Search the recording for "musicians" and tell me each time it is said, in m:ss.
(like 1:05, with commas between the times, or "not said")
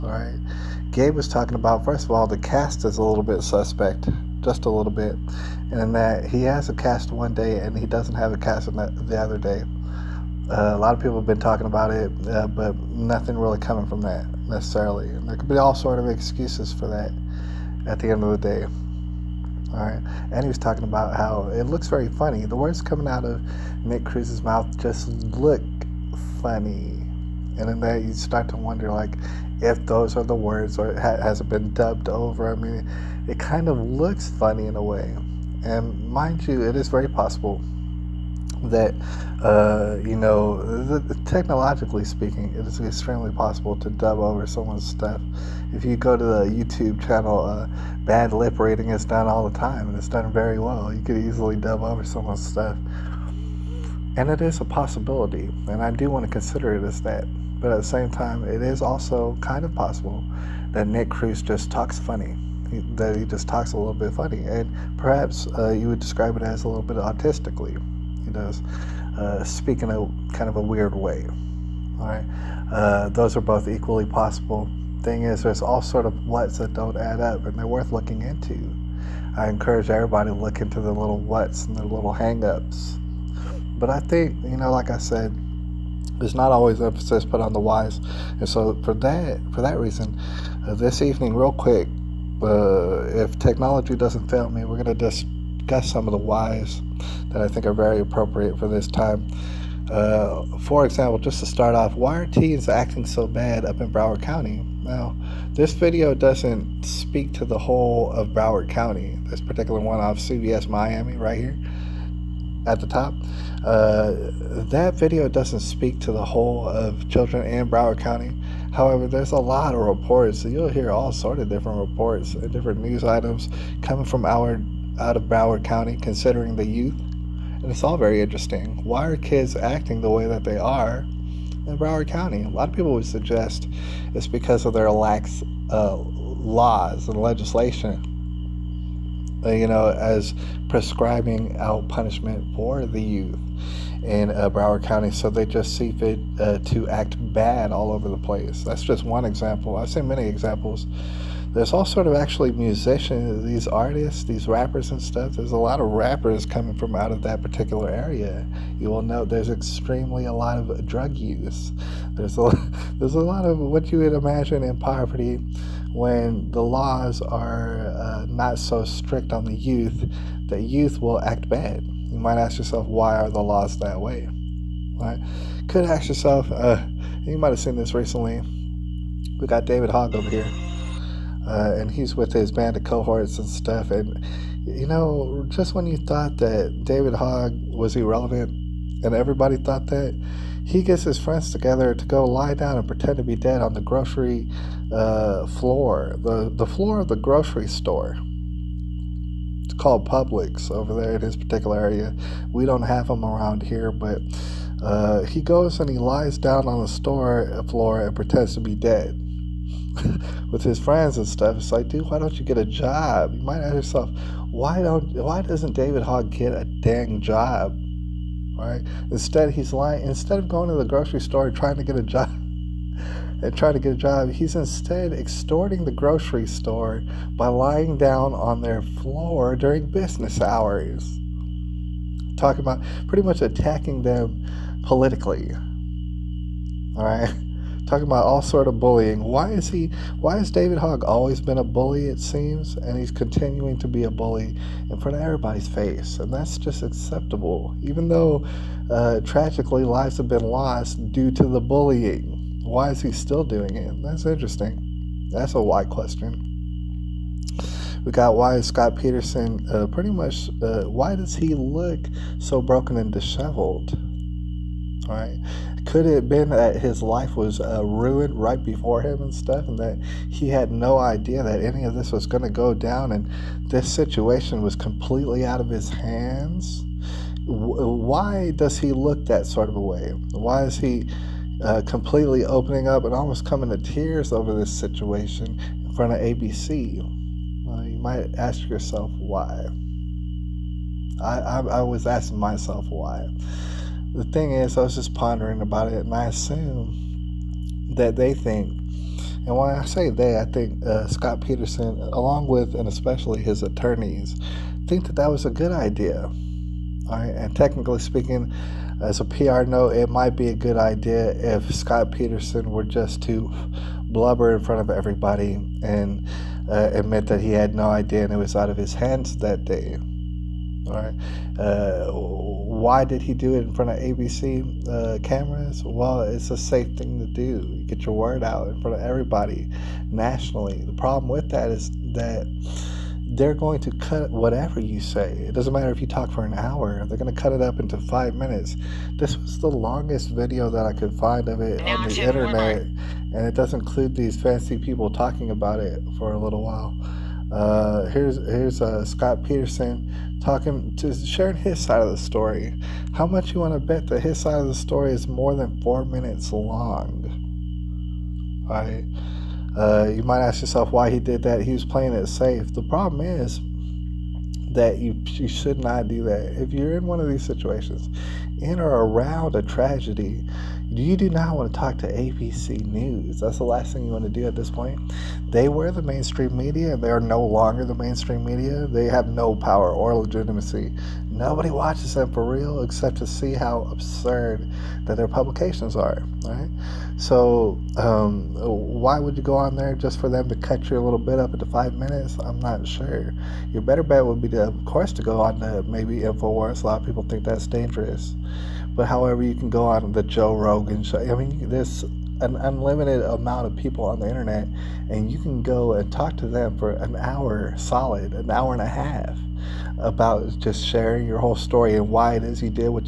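2:32.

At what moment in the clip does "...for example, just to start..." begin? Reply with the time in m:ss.
1:40.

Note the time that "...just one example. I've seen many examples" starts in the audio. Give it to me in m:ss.
2:28.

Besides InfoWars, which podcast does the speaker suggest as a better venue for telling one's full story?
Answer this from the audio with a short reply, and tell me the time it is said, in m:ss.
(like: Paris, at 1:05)
The Joe Rogan show, at 6:40.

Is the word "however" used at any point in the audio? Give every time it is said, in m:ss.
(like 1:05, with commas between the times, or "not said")
1:58, 6:39.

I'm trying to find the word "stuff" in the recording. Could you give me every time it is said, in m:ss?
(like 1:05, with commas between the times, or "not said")
0:44, 0:52, 2:35, 3:03, 3:31, 4:29.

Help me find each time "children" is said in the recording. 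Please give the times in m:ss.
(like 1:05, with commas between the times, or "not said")
1:57.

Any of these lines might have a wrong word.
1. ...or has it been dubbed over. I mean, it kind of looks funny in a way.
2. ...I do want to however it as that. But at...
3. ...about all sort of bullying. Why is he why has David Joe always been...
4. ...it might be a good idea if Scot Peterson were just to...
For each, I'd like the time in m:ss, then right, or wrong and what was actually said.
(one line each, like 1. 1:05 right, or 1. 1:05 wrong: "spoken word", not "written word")
1. 0:30 right
2. 0:55 wrong: "consider", not "however"
3. 3:58 wrong: "Hogg", not "Joe"
4. 5:09 right.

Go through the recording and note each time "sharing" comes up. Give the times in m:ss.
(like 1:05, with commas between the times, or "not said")
5:51, 6:50.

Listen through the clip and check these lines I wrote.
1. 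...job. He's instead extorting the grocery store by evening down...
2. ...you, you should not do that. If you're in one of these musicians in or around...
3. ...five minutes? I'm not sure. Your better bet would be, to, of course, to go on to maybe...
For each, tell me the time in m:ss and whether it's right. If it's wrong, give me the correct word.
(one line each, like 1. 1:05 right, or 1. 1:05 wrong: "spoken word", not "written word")
1. 3:43 wrong: "lying", not "evening"
2. 6:04 wrong: "situations", not "musicians"
3. 6:31 right.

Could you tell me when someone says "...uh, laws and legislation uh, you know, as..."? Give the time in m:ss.
2:15.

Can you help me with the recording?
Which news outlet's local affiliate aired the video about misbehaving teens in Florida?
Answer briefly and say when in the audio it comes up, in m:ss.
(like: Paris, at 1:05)
CBS Miami, at 1:50.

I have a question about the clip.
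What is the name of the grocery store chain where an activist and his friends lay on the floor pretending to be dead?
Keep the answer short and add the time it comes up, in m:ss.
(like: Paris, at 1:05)
Publix, at 3:20.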